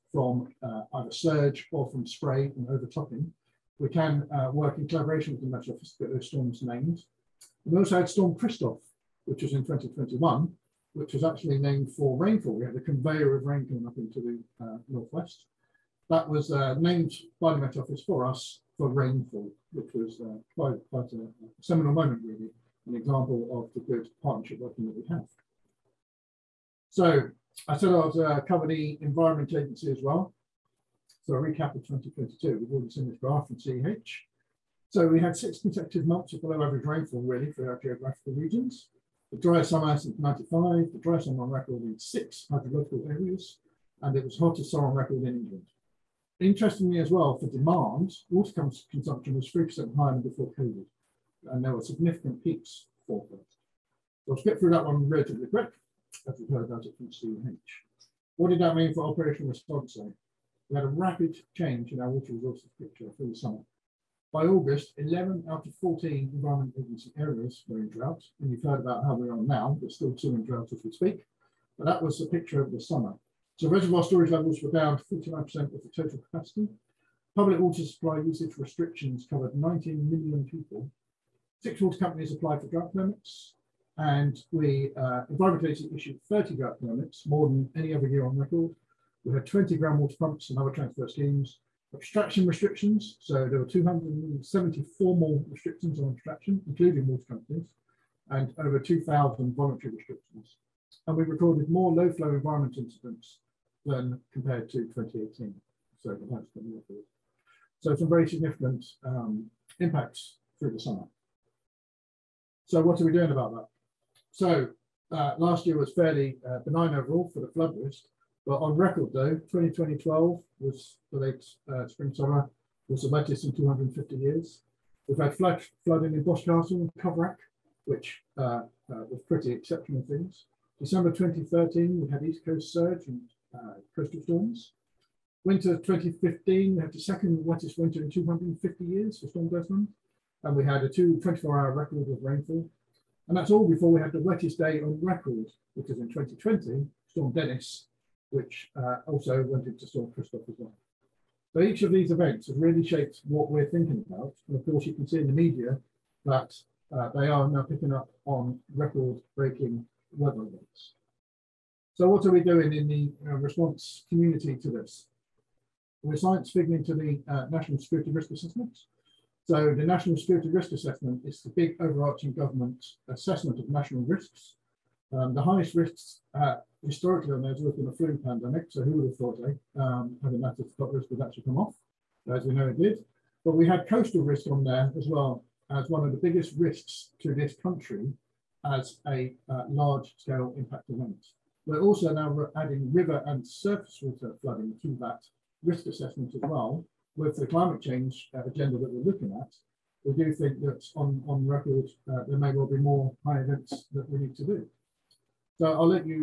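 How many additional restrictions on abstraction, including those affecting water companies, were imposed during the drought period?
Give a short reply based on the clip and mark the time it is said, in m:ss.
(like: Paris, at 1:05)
274, at 1:33.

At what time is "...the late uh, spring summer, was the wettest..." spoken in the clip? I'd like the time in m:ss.
2:01.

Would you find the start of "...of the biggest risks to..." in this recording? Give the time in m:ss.
3:06.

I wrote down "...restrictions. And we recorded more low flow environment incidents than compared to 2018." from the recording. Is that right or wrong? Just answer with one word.
right.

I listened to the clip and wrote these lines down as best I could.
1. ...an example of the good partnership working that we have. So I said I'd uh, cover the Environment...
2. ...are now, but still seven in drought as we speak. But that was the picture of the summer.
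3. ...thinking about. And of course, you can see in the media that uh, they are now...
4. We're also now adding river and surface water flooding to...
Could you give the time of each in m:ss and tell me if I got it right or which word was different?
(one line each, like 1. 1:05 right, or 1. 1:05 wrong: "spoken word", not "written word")
1. 0:22 right
2. 1:09 wrong: "two", not "seven"
3. 2:33 right
4. 3:11 right.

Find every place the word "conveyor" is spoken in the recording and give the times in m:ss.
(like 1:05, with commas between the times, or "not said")
0:12.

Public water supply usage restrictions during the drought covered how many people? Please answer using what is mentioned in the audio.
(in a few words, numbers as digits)
19 million.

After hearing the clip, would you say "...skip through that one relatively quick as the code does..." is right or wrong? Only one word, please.
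right.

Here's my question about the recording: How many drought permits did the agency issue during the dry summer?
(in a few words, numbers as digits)
30.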